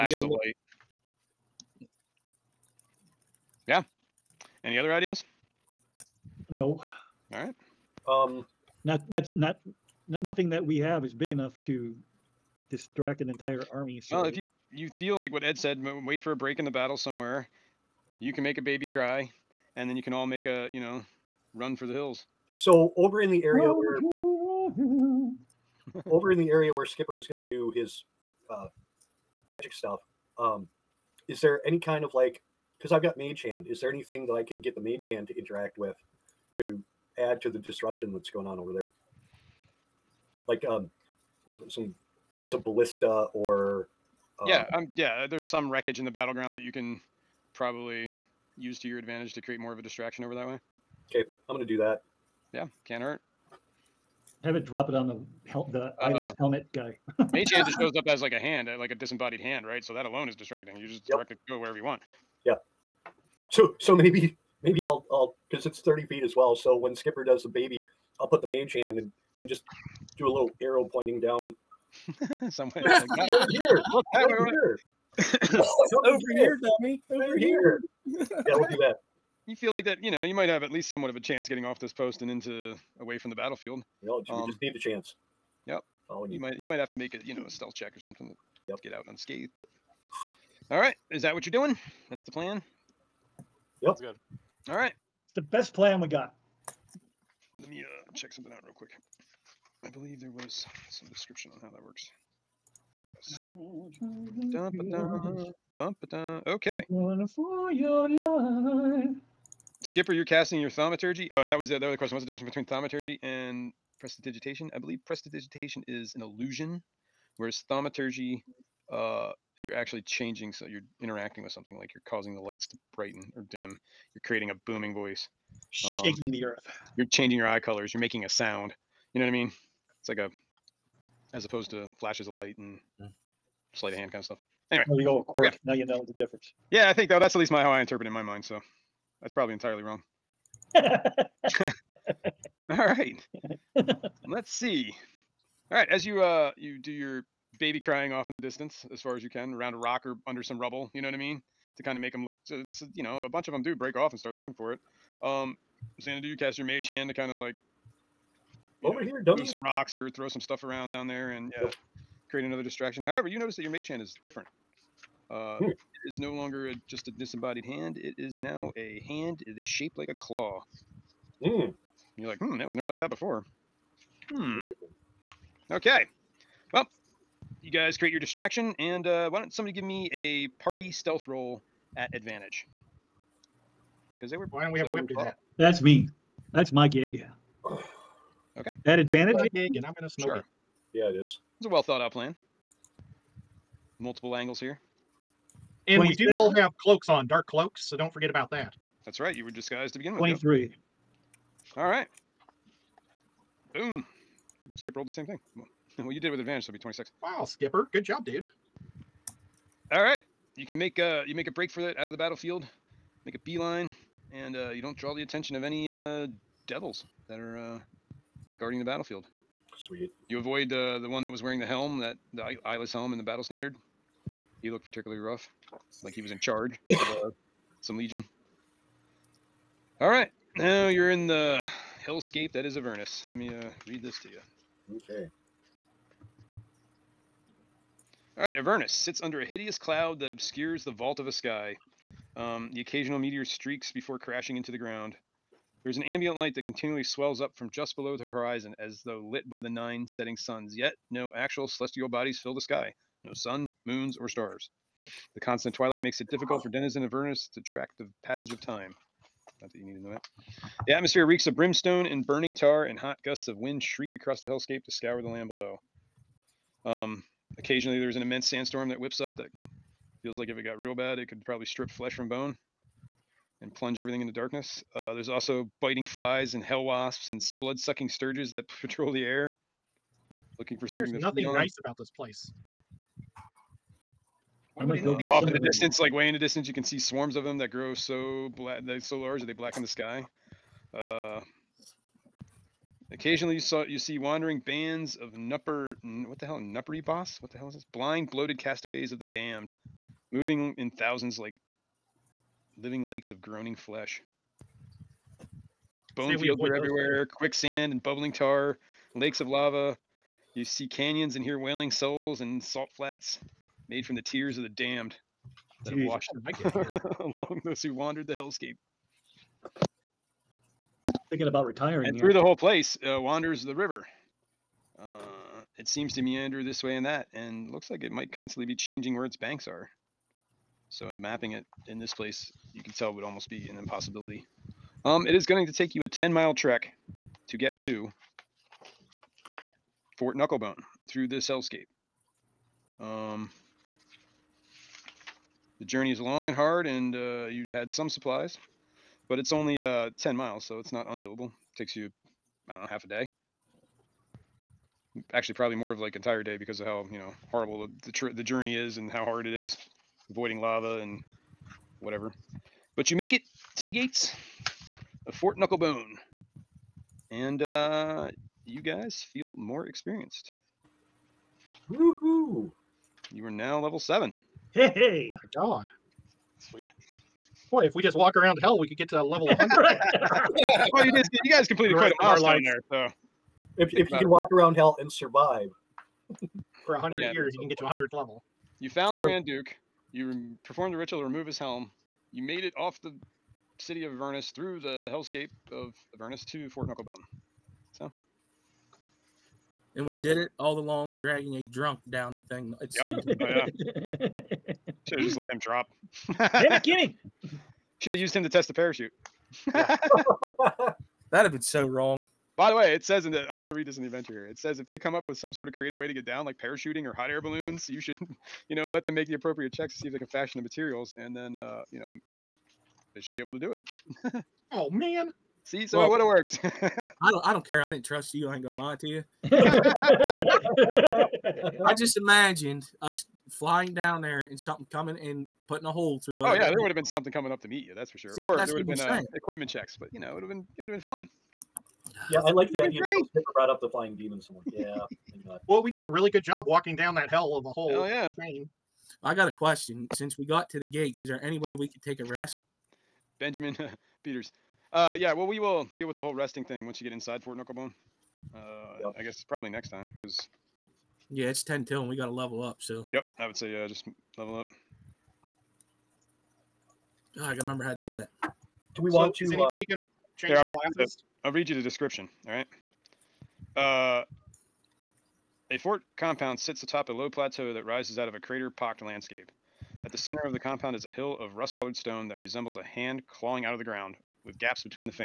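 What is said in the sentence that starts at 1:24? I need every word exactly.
Yeah, you know, um, just need the chance.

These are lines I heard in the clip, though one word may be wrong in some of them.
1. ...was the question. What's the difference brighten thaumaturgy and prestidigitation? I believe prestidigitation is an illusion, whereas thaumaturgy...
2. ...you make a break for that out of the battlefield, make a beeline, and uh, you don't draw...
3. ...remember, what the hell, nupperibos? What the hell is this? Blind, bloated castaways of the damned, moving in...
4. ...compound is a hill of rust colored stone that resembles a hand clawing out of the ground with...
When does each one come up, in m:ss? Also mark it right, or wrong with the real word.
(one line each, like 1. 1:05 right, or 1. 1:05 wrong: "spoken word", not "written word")
1. 1:51 wrong: "between", not "brighten"
2. 3:31 right
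3. 4:55 wrong: "nupper", not "remember"
4. 8:00 right.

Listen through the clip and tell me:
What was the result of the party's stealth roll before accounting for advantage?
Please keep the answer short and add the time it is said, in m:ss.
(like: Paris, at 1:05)
23, at 3:20.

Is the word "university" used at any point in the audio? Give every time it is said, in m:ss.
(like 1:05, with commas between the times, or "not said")
not said.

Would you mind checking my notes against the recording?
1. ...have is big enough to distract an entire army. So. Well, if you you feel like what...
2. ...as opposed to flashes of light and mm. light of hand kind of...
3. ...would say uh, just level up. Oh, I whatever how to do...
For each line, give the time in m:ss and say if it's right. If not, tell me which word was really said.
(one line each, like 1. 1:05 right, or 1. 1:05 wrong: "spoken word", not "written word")
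1. 0:10 right
2. 2:11 wrong: "sleight", not "light"
3. 7:43 wrong: "remember", not "whatever".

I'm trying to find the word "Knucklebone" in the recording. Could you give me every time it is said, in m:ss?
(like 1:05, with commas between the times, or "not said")
5:40, 6:05, 6:36, 7:37.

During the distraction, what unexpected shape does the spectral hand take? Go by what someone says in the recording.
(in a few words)
A claw.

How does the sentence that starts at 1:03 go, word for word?
So so maybe maybe I'll I'll because it's 30 feet as well.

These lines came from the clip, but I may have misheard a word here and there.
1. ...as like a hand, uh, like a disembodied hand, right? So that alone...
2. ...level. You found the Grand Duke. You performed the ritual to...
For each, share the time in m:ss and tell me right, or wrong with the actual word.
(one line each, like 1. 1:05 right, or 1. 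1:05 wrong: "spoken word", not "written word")
1. 0:58 right
2. 6:28 right.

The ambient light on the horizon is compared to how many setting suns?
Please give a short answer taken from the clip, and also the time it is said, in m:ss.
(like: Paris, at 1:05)
9, at 4:09.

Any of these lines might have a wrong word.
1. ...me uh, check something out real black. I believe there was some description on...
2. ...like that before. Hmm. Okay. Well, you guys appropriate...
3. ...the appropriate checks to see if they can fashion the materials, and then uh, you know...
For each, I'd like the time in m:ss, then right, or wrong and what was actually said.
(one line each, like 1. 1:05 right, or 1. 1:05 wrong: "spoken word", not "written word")
1. 1:37 wrong: "quick", not "black"
2. 2:52 wrong: "create", not "appropriate"
3. 6:59 right.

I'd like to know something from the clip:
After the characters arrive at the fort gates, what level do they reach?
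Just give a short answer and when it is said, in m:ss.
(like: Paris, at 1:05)
7, at 6:13.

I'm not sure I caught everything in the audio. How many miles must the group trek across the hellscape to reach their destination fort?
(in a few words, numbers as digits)
10.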